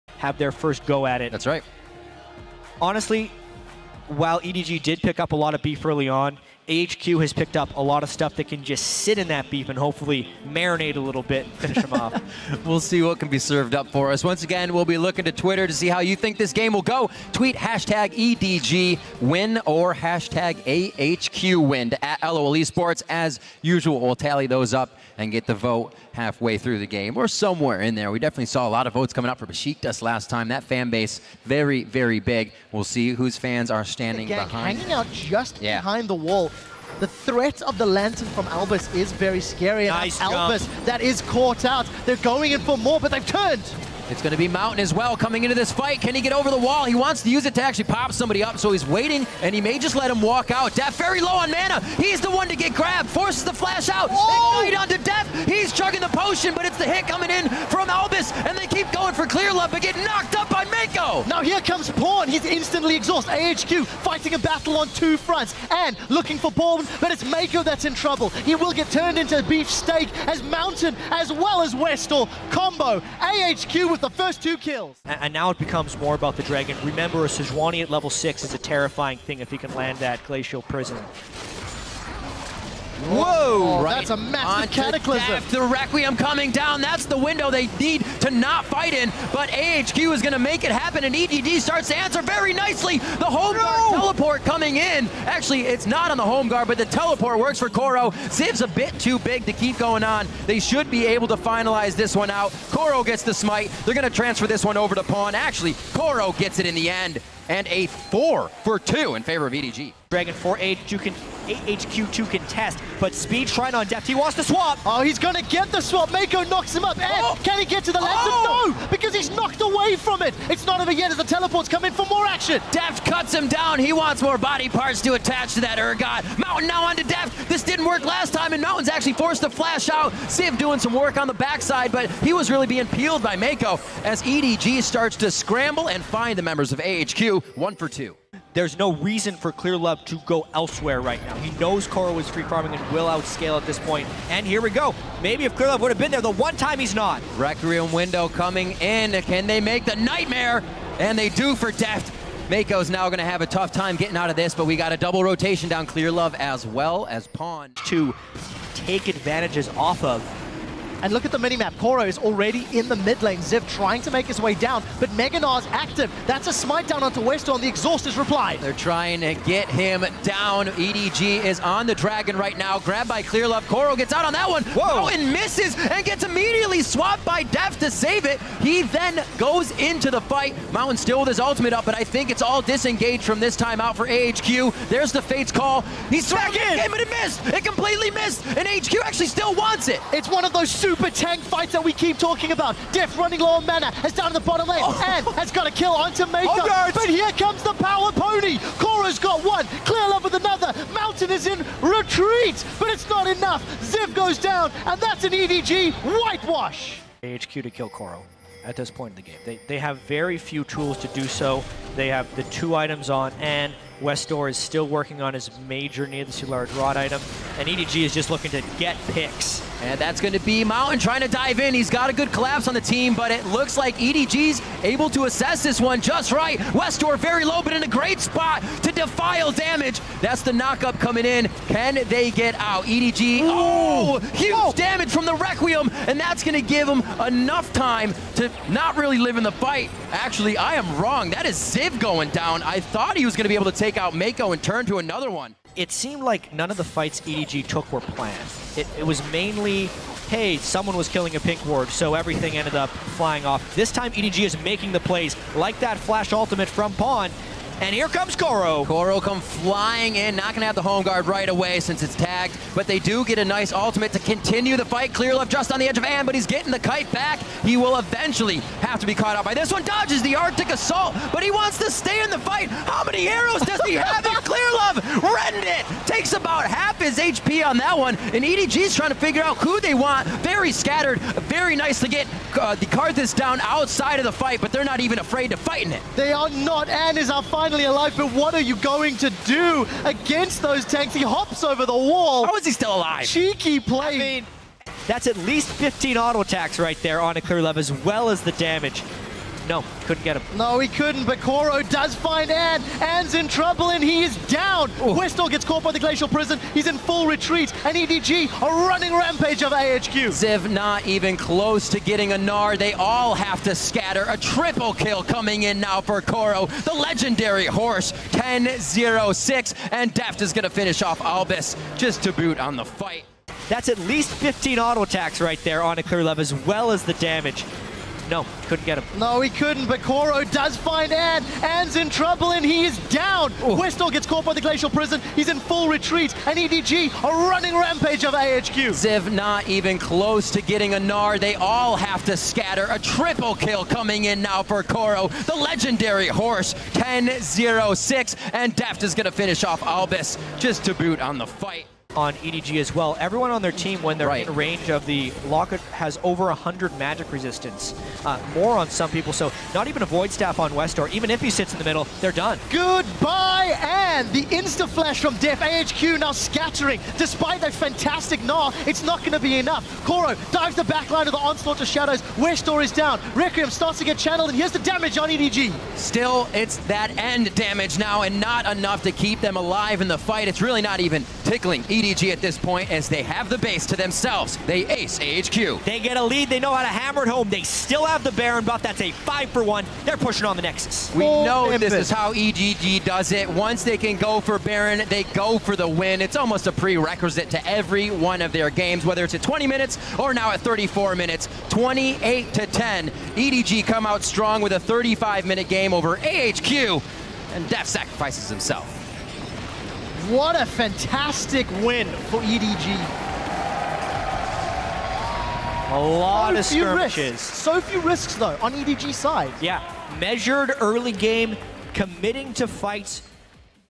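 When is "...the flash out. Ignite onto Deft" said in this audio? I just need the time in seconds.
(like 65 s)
53 s.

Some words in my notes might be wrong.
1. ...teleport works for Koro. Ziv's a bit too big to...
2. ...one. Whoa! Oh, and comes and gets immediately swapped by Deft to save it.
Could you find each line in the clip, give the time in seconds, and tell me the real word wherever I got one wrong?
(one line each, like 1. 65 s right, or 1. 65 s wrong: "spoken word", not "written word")
1. 96 s right
2. 174 s wrong: "misses", not "comes".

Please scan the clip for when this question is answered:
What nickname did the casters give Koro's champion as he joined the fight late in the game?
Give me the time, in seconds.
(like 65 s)
197 s.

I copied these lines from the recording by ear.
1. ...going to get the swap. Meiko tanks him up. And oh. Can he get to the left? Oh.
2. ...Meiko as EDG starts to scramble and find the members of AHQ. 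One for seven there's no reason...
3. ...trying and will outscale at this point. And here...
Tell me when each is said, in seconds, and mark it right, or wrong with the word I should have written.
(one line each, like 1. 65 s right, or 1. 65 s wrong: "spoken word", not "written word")
1. 115 s wrong: "knocks", not "tanks"
2. 133 s wrong: "two", not "seven"
3. 142 s wrong: "farming", not "trying".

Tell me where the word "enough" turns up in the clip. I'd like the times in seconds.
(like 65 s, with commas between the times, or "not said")
203 s, 237 s, 369 s, 378 s.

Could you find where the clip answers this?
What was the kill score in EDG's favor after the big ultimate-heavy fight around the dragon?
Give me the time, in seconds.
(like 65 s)
107 s.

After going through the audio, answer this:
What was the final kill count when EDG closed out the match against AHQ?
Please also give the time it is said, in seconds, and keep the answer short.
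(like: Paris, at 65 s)
28 to 10, at 401 s.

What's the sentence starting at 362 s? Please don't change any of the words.
Good by and the insta-flash from Deft.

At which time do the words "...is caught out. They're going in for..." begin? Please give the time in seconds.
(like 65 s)
41 s.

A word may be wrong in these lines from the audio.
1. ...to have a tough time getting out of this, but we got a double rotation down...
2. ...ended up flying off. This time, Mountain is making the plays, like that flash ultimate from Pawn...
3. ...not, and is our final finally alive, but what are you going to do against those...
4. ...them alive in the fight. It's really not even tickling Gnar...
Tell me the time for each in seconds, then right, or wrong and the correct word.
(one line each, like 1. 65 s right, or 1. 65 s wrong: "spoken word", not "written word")
1. 153 s right
2. 252 s wrong: "EDG", not "Mountain"
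3. 286 s right
4. 379 s wrong: "EDG", not "Gnar".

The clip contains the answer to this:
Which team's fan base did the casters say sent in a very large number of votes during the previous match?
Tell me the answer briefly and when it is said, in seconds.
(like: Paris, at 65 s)
Besiktas, at 29 s.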